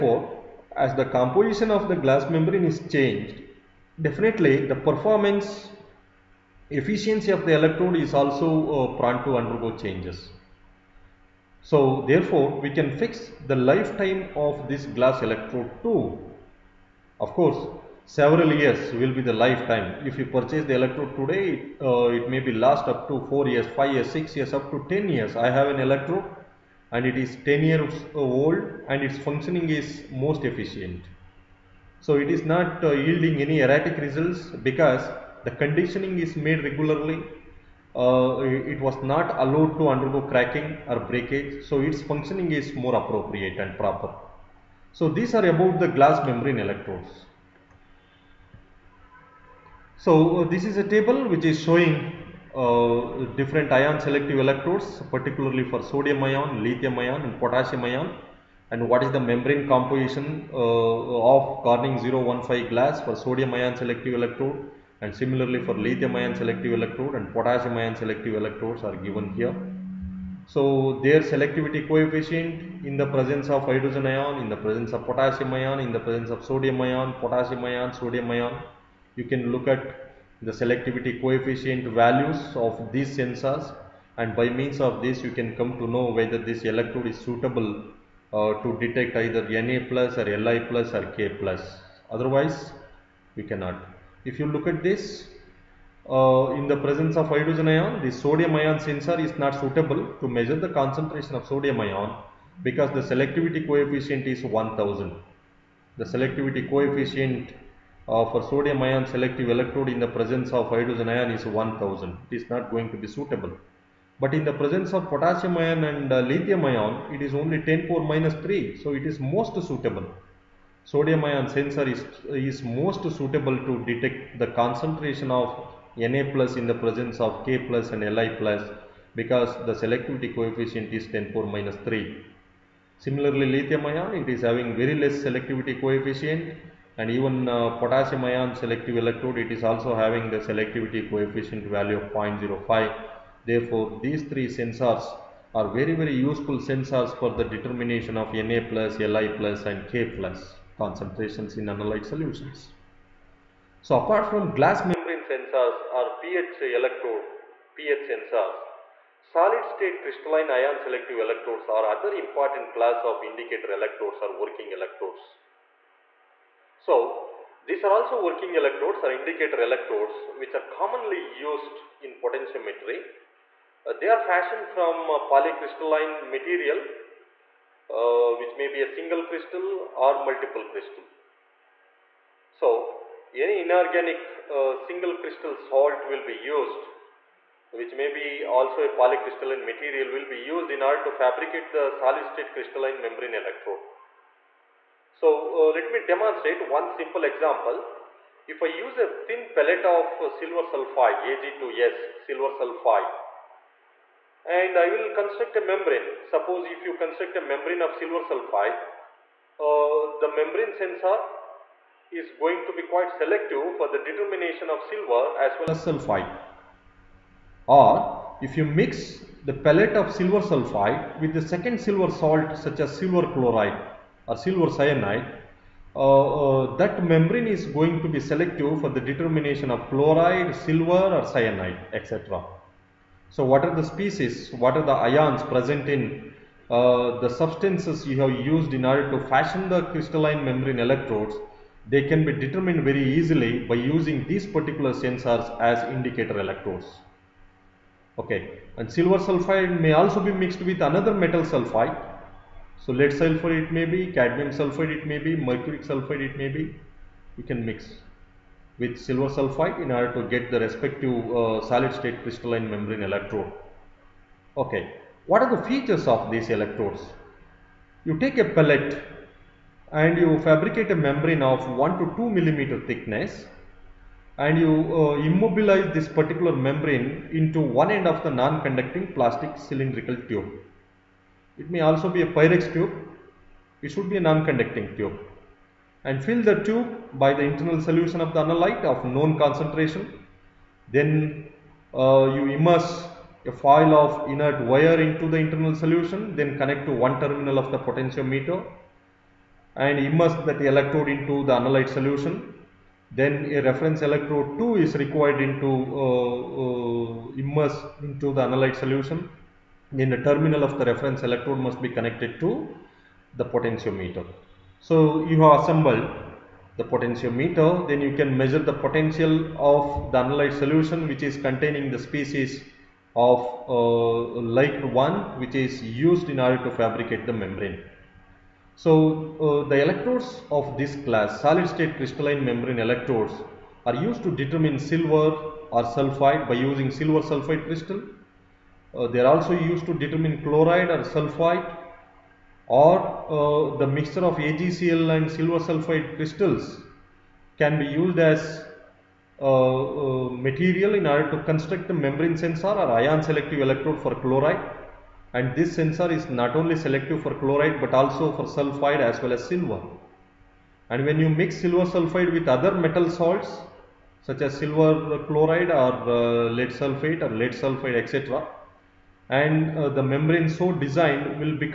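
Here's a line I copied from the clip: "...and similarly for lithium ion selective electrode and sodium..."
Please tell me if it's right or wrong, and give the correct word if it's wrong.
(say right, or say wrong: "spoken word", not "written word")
wrong: "potassium", not "sodium".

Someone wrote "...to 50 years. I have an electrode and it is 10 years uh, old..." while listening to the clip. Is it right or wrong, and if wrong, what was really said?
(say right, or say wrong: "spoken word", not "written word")
wrong: "10", not "50".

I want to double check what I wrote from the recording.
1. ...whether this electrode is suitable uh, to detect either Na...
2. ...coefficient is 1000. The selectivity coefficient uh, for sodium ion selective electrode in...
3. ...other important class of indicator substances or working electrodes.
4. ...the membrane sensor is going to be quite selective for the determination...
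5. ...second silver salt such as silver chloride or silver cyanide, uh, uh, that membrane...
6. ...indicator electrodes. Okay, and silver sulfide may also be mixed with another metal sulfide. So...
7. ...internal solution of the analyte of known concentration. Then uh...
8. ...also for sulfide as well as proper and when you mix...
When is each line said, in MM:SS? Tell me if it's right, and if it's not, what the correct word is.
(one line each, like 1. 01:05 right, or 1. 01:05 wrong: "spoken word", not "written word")
1. 01:26 right
2. 01:43 right
3. 02:41 wrong: "electrodes", not "substances"
4. 03:30 right
5. 03:41 right
6. 04:05 right
7. 04:47 right
8. 05:57 wrong: "silver", not "proper".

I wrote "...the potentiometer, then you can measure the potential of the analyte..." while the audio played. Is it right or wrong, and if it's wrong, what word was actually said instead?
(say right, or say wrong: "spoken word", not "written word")
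right.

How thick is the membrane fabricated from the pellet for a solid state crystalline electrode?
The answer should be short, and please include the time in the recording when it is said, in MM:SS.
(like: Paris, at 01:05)
1 to 2 millimeters, at 04:31.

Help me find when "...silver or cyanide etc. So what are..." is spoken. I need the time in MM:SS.
03:50.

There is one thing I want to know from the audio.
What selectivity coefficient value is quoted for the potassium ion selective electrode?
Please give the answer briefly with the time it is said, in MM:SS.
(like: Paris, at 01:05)
0.05, at 02:22.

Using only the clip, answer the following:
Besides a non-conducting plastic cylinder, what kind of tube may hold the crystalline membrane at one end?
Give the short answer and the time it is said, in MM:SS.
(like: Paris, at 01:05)
Pyrex tube, at 04:42.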